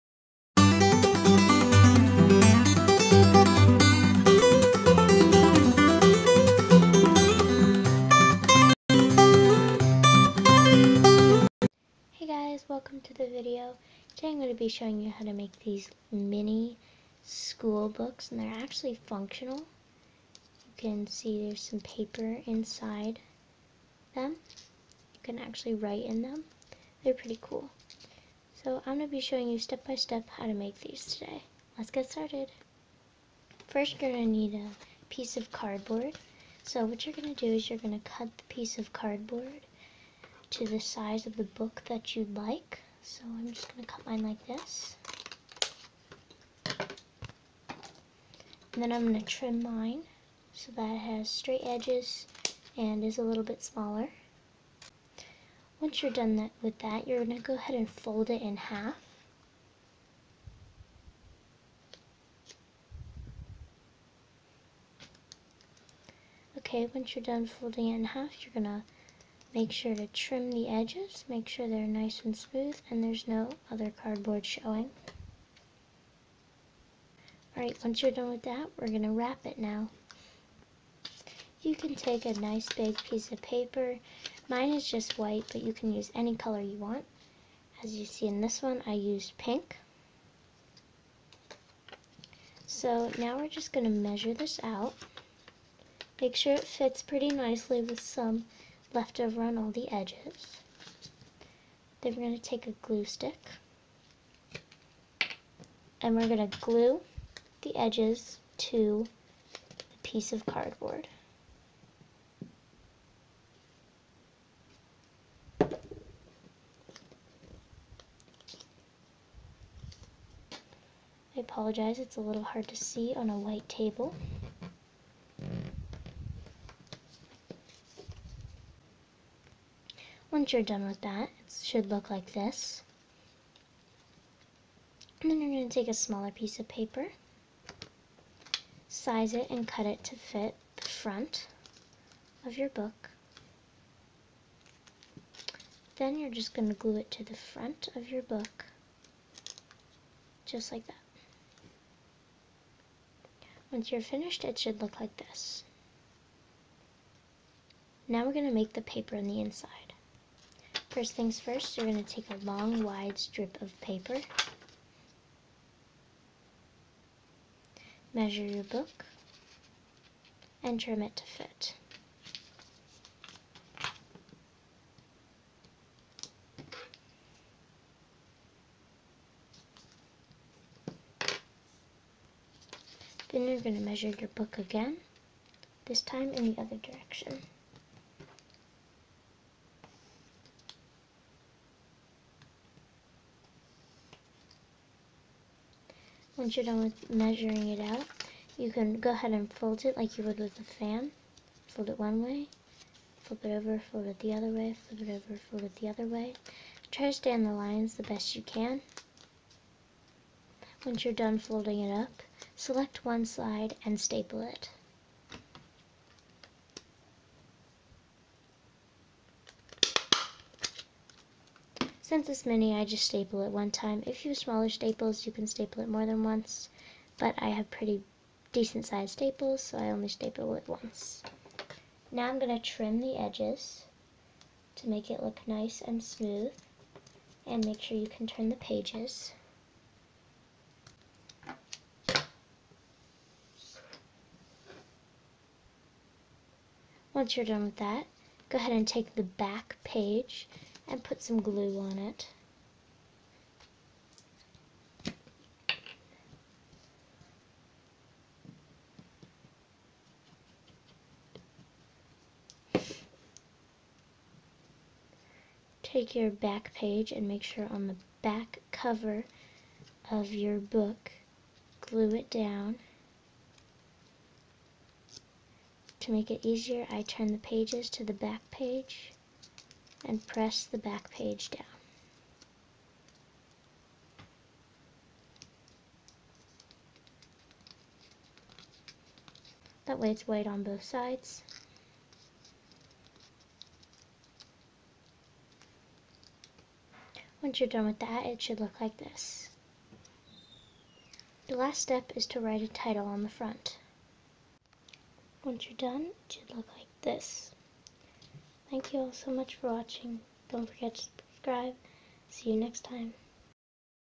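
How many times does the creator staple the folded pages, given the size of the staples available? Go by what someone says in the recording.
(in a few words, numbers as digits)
1.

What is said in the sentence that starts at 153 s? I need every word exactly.
Once you're finished, it should look like this.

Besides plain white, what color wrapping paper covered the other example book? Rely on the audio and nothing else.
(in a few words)
pink.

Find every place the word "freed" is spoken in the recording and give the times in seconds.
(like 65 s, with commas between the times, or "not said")
not said.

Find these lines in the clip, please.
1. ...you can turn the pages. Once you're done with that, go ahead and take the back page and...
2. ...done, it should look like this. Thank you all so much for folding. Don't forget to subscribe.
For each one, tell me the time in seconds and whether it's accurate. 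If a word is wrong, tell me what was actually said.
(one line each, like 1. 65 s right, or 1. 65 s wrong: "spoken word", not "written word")
1. 237 s right
2. 305 s wrong: "watching", not "folding".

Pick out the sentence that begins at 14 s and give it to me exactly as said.
Today I'm going to be showing you how to make these mini school books and they're actually functional.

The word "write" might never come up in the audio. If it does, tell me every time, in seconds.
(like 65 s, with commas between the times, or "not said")
25 s, 302 s.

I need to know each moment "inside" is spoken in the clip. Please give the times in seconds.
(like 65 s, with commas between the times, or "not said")
22 s, 159 s.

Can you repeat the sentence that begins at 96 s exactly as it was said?
Make sure it fits pretty nicely with some left over on all the edges.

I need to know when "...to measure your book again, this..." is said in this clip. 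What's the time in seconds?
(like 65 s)
183 s.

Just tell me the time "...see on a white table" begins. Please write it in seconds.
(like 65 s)
122 s.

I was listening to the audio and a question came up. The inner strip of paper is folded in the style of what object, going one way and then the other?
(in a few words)
a fan.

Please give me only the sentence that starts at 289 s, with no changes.
That way it's white on both sides.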